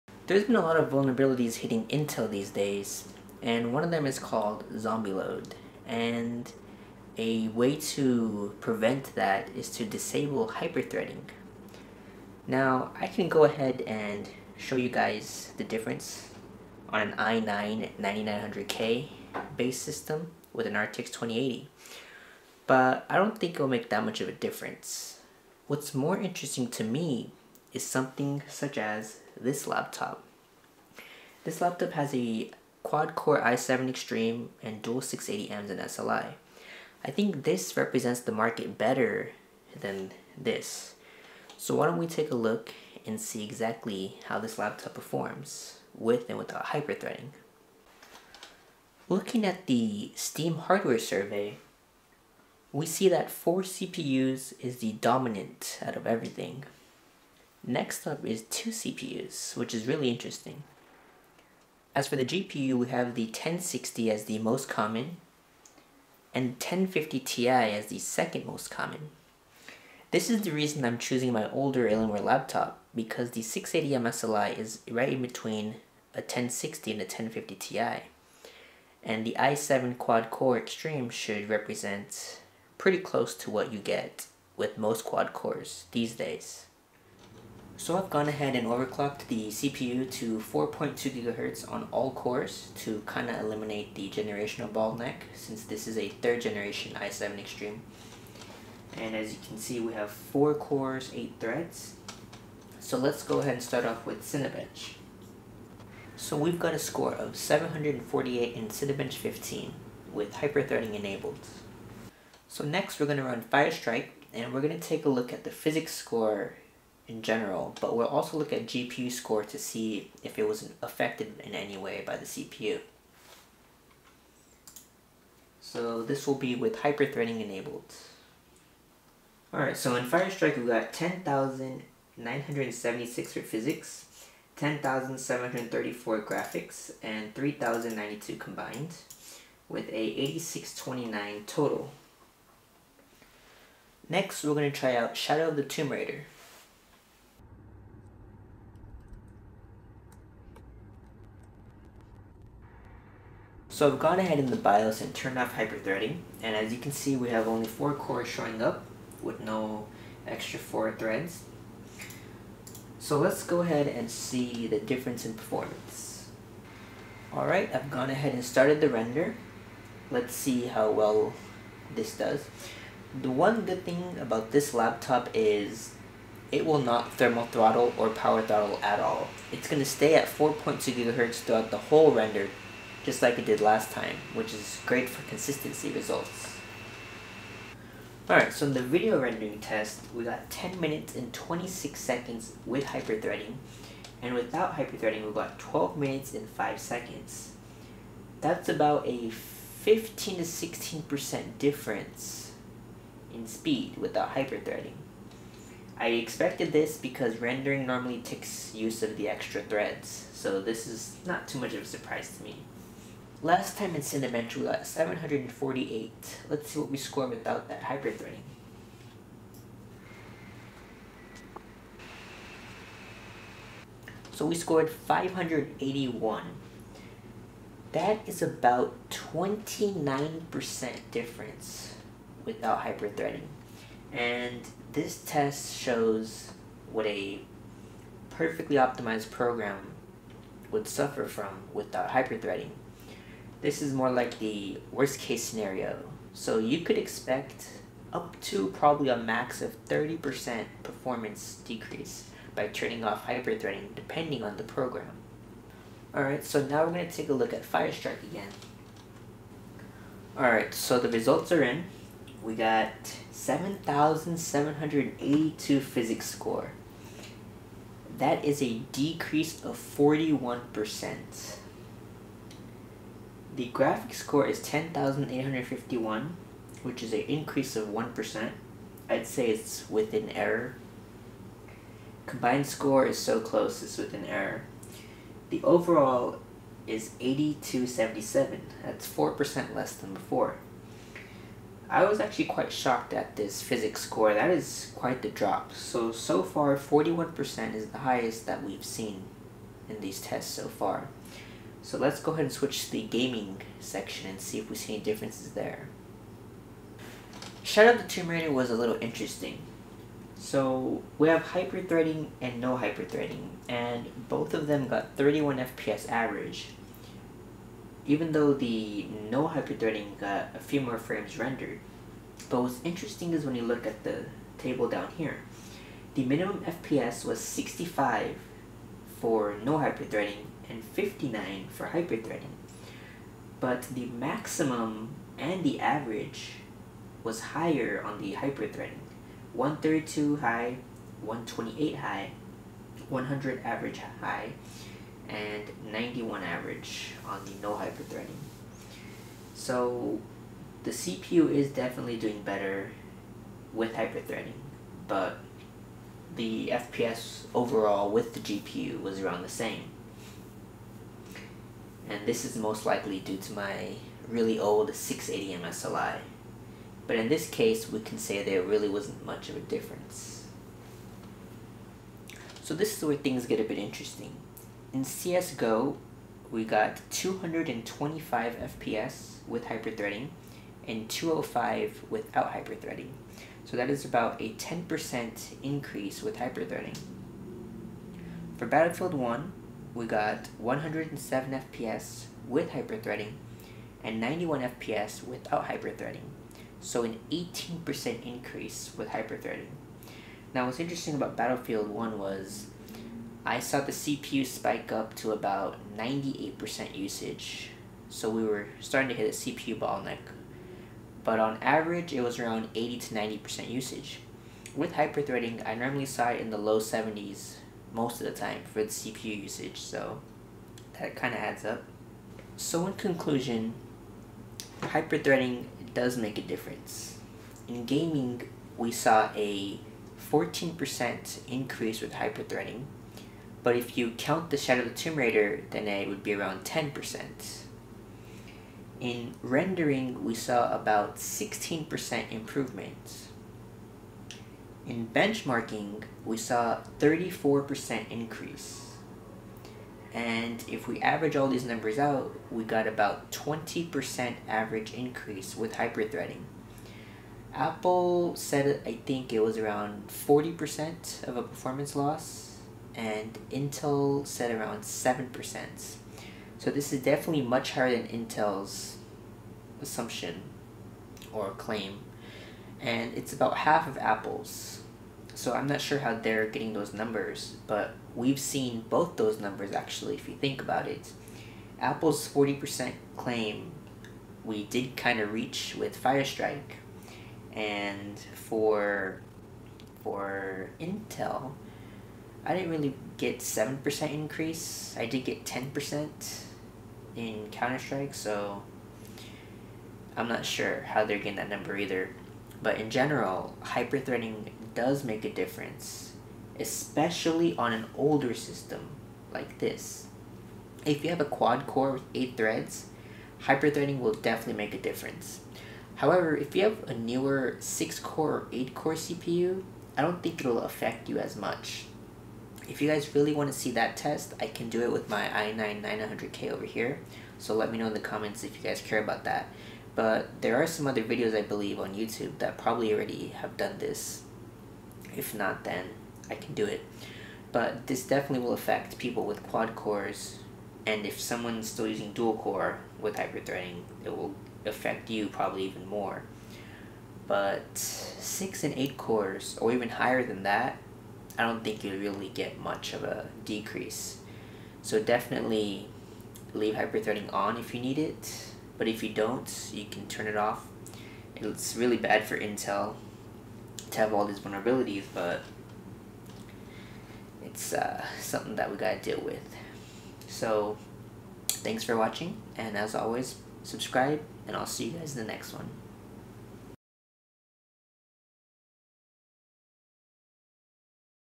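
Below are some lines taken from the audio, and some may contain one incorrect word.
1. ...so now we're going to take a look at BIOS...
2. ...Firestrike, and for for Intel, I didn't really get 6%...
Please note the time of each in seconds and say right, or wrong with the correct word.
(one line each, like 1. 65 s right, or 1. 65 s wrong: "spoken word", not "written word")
1. 256 s wrong: "Firestrike", not "BIOS"
2. 486 s wrong: "7", not "6".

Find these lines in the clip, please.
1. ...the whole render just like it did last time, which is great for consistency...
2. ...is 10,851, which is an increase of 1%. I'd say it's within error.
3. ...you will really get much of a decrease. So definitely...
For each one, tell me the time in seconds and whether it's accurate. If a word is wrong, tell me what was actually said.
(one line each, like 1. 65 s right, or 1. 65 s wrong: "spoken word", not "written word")
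1. 181 s right
2. 274 s right
3. 551 s right.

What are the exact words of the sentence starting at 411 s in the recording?
But on average, it was around 80 to 90% usage.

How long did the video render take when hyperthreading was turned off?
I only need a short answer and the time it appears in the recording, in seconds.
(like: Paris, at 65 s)
12 minutes 5 seconds, at 195 s.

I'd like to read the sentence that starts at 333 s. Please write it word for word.
But the maximum and the average was higher on the hyperthreading.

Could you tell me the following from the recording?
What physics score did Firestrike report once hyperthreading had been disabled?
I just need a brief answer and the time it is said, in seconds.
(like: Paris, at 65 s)
7,782, at 263 s.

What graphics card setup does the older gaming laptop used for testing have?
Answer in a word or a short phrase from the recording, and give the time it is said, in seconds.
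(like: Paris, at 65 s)
Dual 680Ms in SLI, at 34 s.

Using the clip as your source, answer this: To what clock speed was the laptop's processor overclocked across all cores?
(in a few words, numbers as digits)
4.2 GHz.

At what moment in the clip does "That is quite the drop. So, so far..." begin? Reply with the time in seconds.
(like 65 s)
294 s.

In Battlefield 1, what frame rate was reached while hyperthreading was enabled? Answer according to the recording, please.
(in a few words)
107 FPS.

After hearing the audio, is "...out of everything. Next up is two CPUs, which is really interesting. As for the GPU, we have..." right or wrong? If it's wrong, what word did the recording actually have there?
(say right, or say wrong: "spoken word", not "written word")
right.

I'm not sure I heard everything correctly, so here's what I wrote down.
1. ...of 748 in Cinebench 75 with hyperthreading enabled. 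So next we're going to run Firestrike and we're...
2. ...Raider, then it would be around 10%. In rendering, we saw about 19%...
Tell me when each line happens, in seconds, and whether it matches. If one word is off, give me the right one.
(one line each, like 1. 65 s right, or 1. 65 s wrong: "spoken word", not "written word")
1. 107 s wrong: "15", not "75"
2. 435 s wrong: "16", not "19".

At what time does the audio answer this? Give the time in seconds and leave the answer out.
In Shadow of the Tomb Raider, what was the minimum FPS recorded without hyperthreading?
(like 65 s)
327 s.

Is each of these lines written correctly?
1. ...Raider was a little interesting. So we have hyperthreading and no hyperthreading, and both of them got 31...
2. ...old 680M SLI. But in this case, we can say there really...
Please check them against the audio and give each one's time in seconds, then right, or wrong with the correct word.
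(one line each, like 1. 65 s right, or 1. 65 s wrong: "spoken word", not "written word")
1. 308 s right
2. 364 s right.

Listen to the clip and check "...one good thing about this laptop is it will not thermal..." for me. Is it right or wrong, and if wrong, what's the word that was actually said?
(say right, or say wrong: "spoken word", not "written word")
right.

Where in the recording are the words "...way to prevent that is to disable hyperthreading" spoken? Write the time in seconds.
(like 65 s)
7 s.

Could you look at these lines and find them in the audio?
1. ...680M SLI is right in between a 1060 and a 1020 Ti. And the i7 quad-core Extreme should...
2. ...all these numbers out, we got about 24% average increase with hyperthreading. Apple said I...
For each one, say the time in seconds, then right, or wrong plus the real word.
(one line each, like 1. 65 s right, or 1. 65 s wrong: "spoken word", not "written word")
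1. 73 s wrong: "1050", not "1020"
2. 451 s wrong: "20", not "24".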